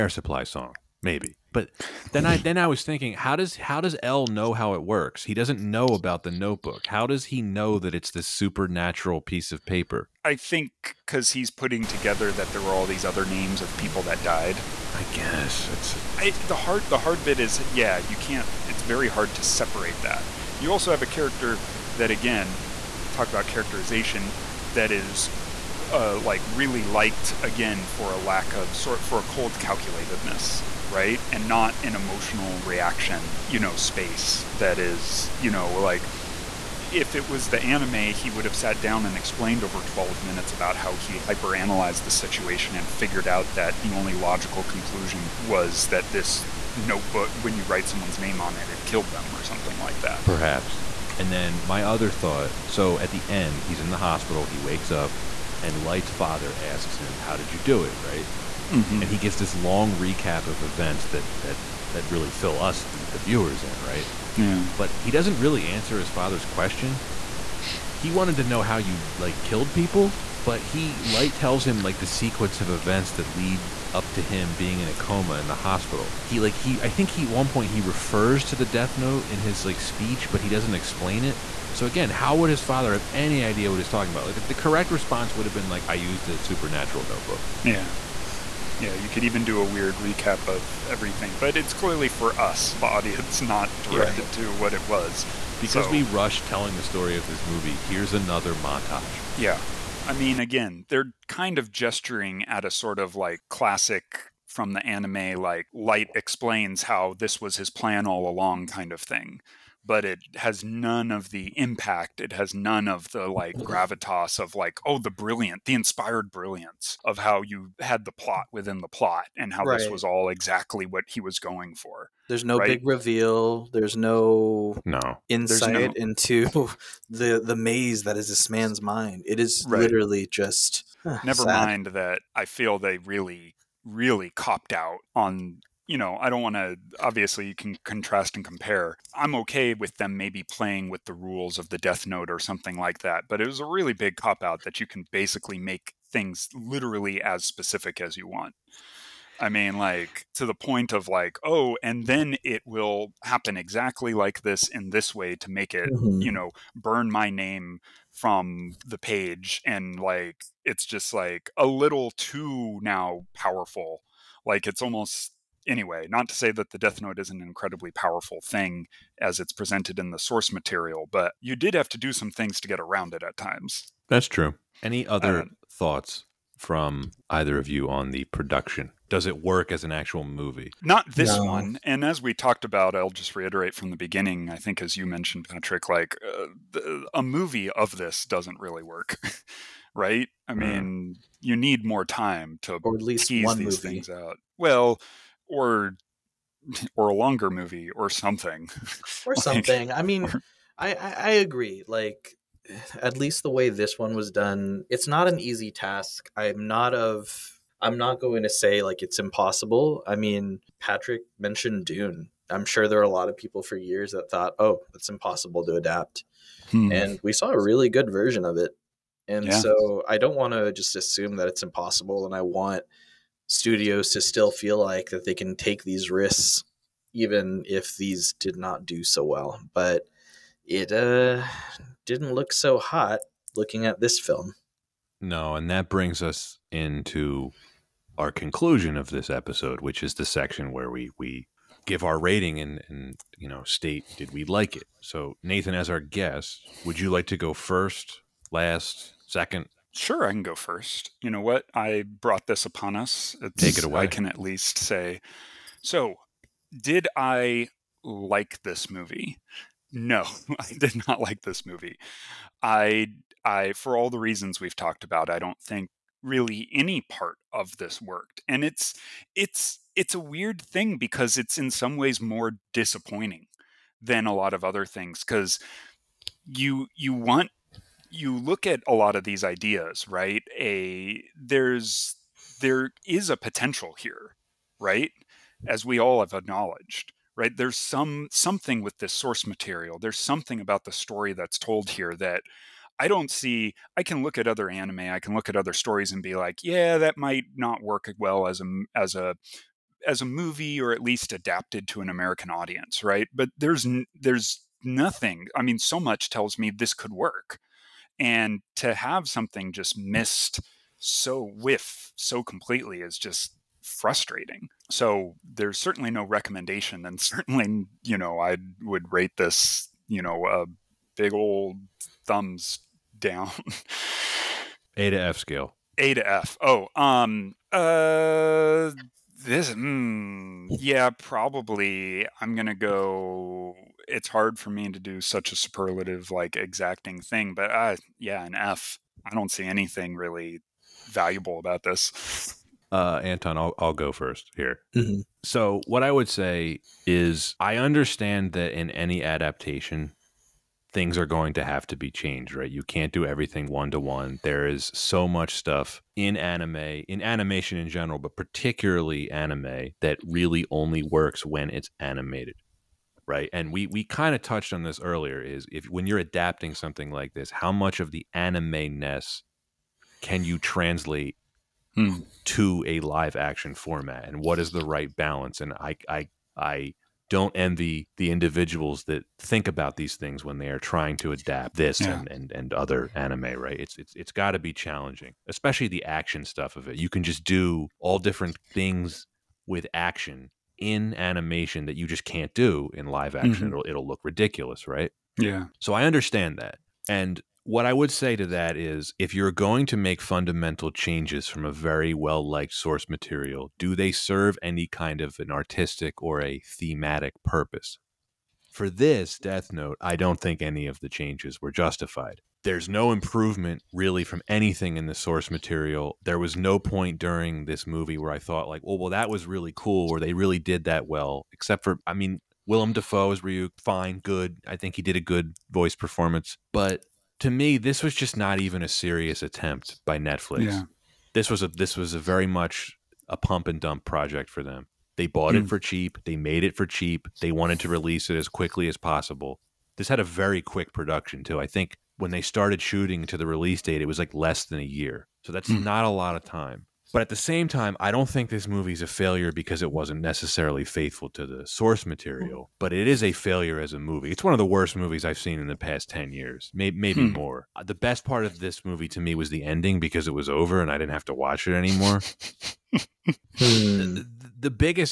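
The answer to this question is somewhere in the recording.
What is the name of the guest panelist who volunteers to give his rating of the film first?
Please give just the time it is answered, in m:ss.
4:05.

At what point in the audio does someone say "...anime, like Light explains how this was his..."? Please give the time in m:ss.
1:44.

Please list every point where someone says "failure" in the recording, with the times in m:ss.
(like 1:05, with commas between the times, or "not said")
7:29, 7:33.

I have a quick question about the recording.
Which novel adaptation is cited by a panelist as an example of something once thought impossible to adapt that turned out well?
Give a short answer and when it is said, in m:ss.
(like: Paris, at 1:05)
Dune, at 3:31.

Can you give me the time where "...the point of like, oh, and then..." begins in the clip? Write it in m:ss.
2:30.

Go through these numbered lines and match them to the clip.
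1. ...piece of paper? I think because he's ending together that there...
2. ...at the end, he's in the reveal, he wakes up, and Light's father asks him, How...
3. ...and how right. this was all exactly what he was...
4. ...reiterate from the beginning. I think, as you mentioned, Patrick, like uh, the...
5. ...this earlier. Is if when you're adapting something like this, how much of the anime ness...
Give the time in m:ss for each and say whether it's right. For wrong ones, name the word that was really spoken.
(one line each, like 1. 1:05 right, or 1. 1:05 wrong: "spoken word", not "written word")
1. 0:09 wrong: "putting", not "ending"
2. 0:52 wrong: "hospital", not "reveal"
3. 1:59 right
4. 3:03 right
5. 6:04 right.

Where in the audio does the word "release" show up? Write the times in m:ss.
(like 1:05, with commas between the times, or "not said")
7:17, 7:23.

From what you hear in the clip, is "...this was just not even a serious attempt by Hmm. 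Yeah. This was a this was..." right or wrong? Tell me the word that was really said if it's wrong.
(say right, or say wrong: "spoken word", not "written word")
wrong: "Netflix", not "Hmm".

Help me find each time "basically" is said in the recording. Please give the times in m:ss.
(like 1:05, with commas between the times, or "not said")
2:25.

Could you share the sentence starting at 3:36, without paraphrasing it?
and we saw a really good version of it and yeah.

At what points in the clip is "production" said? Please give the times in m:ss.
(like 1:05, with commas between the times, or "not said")
2:58, 7:20.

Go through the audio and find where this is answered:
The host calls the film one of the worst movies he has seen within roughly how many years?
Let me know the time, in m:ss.
7:36.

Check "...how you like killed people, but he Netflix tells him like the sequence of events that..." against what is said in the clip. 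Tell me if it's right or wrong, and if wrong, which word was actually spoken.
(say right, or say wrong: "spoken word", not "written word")
wrong: "Light", not "Netflix".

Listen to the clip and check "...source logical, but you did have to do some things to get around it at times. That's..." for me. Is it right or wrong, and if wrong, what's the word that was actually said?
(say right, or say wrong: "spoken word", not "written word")
wrong: "material", not "logical".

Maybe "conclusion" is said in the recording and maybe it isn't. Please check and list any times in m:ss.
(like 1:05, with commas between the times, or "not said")
0:44, 3:58.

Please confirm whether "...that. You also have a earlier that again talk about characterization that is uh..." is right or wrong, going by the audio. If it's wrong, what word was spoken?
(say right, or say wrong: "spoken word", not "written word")
wrong: "character", not "earlier".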